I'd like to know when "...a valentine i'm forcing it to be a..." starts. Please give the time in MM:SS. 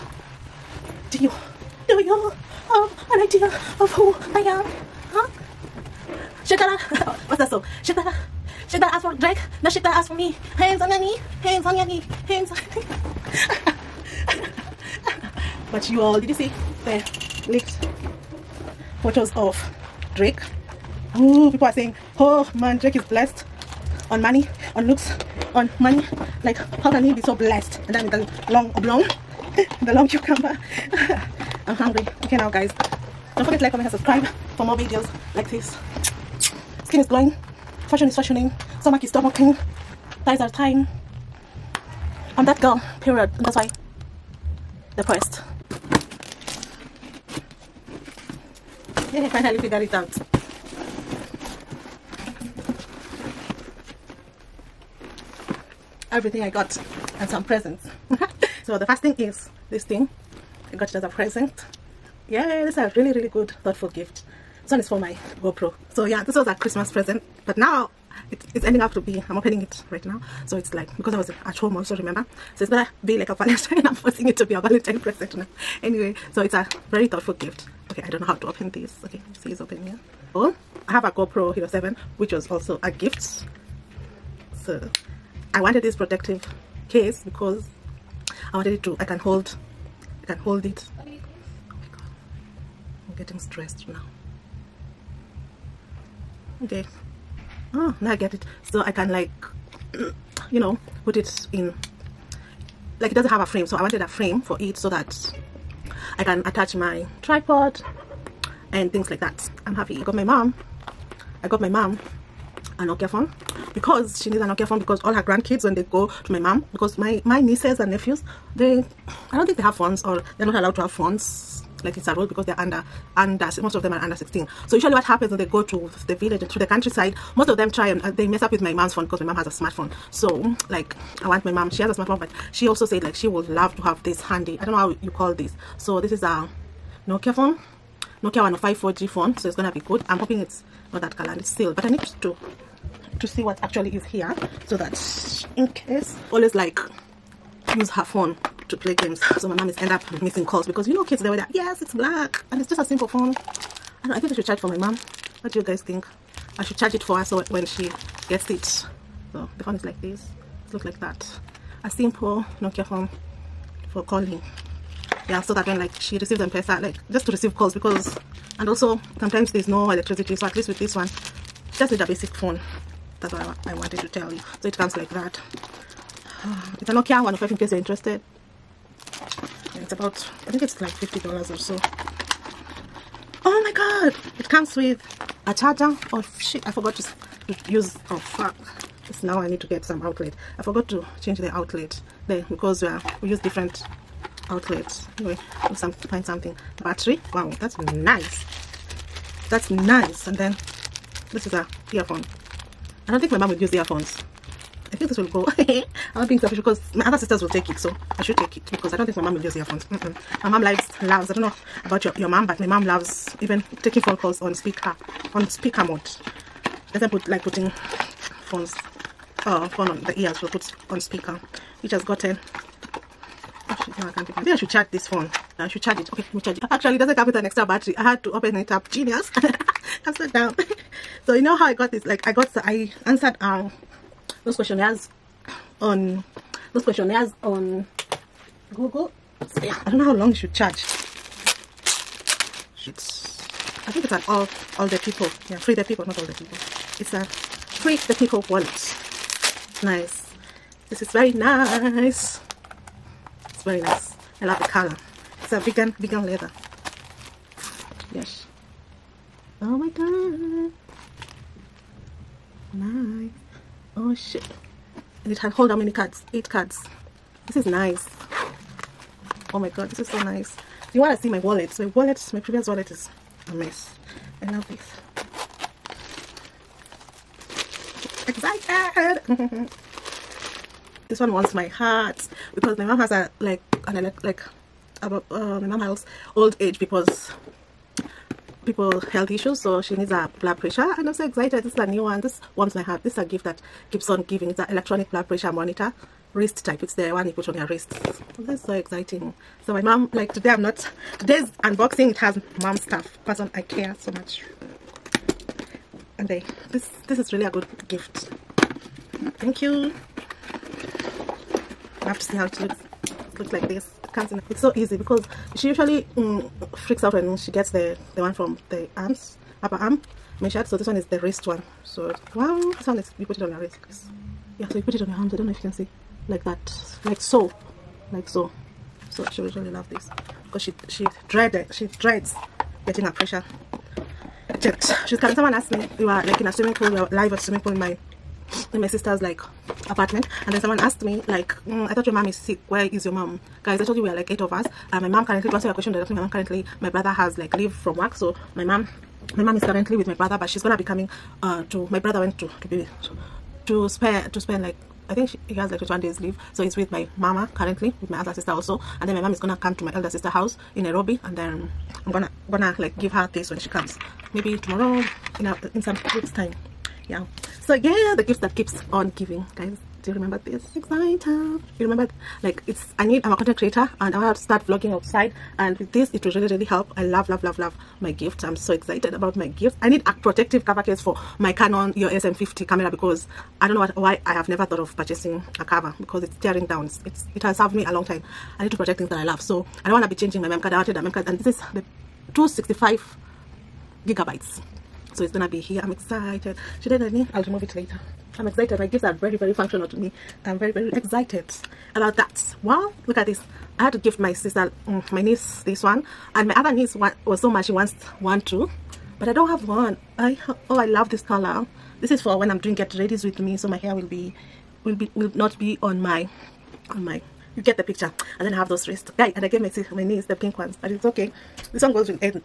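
01:13.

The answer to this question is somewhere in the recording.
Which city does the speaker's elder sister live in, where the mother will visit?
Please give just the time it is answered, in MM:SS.
06:00.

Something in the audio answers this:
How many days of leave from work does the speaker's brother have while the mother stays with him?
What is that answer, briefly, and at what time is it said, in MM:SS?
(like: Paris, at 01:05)
21, at 05:55.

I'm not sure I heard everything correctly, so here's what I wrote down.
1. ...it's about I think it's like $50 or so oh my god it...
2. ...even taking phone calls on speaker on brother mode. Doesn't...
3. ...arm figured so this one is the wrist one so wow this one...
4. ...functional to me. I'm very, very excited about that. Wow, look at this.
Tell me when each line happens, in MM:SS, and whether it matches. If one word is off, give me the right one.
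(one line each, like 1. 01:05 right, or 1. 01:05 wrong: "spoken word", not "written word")
1. 02:59 right
2. 03:33 wrong: "speaker", not "brother"
3. 05:19 wrong: "measured", not "figured"
4. 06:39 right.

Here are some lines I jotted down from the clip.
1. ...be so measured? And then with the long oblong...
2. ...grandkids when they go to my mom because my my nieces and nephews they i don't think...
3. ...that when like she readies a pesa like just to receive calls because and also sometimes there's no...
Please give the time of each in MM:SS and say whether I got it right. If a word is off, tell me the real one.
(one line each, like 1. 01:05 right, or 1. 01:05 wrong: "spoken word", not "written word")
1. 00:27 wrong: "blessed", not "measured"
2. 01:55 right
3. 02:45 wrong: "receives", not "readies".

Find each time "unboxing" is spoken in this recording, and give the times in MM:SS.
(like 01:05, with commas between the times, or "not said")
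05:01.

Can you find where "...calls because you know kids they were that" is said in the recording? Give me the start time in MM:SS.
02:30.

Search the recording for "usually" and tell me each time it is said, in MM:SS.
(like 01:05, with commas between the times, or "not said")
02:04, 05:15.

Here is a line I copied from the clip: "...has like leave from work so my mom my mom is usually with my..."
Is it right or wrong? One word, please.
wrong.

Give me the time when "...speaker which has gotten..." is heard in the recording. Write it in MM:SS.
03:40.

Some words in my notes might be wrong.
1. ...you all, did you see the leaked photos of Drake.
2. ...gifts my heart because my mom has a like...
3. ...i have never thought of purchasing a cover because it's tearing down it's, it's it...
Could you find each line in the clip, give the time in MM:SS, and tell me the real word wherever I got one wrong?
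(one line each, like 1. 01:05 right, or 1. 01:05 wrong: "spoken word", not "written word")
1. 00:15 right
2. 04:41 wrong: "wants", not "gifts"
3. 06:24 right.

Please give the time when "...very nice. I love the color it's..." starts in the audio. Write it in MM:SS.
04:13.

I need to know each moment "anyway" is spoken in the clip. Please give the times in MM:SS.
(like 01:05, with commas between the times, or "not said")
01:15, 03:15.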